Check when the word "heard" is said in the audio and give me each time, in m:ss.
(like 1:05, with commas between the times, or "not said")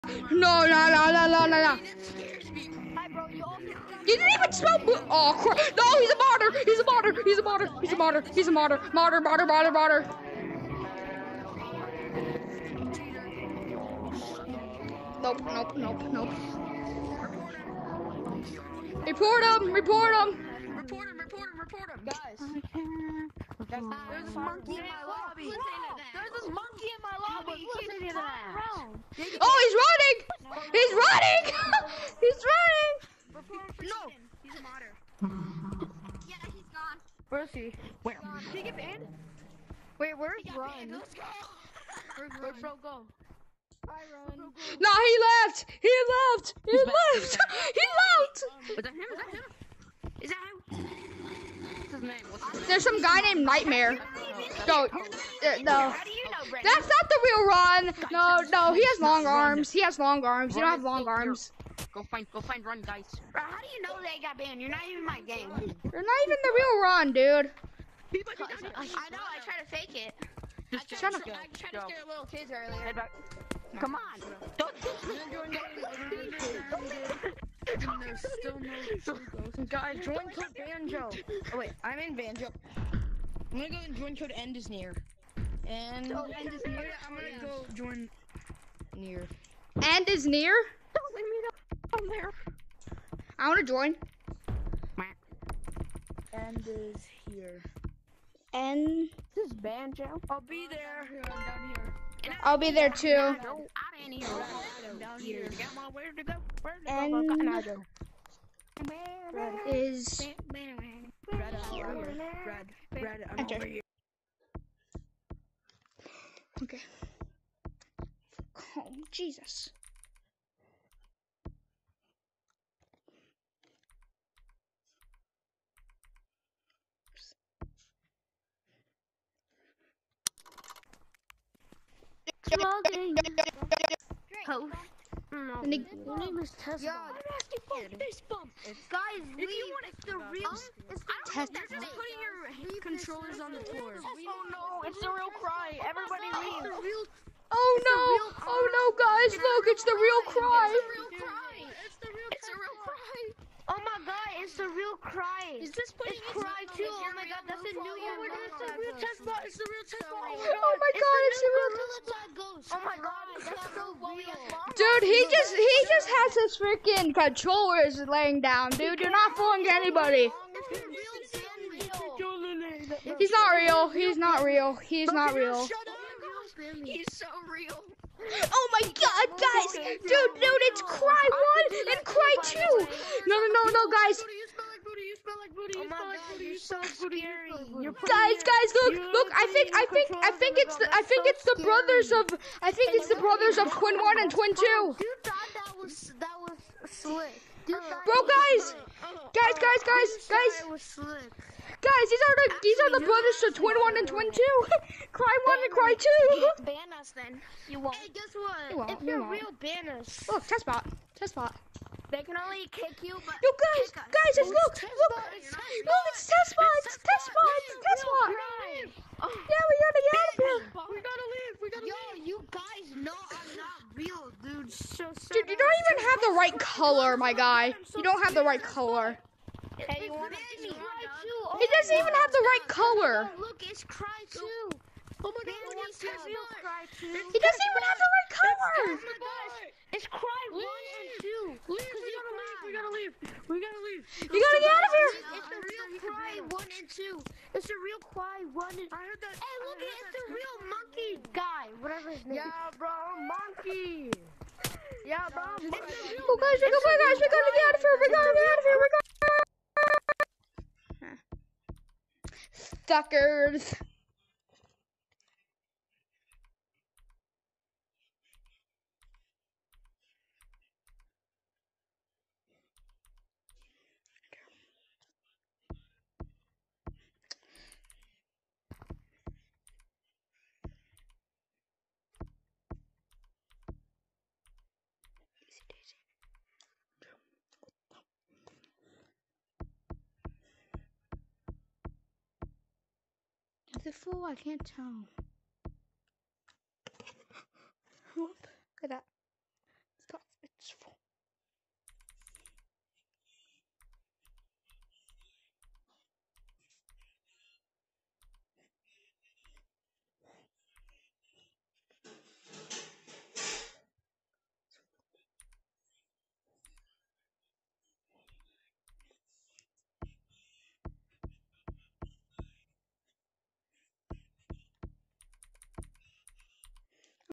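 4:09.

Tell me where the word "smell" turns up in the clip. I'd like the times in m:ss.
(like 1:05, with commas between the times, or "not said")
0:04, 3:05.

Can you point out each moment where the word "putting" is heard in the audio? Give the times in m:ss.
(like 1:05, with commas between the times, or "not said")
2:21, 2:35.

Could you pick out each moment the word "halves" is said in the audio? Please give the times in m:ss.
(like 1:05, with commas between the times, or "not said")
not said.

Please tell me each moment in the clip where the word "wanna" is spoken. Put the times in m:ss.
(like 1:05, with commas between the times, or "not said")
1:33.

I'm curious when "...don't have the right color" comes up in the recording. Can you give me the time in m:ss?
3:48.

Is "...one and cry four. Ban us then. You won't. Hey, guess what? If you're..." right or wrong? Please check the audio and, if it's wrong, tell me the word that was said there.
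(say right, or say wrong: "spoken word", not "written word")
wrong: "two", not "four".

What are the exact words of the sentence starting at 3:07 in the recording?
You You Guys, guys, look, look.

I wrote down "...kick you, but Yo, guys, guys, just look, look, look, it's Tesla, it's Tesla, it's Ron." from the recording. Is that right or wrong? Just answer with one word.
wrong.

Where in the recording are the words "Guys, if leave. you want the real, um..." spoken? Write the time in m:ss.
2:18.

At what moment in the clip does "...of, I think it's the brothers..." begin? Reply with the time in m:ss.
3:12.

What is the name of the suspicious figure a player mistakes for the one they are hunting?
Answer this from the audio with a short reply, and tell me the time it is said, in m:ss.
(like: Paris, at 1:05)
Nightmare, at 0:53.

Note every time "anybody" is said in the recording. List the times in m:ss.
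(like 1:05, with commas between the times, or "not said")
2:49.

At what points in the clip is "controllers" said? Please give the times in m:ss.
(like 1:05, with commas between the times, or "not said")
2:22, 2:47.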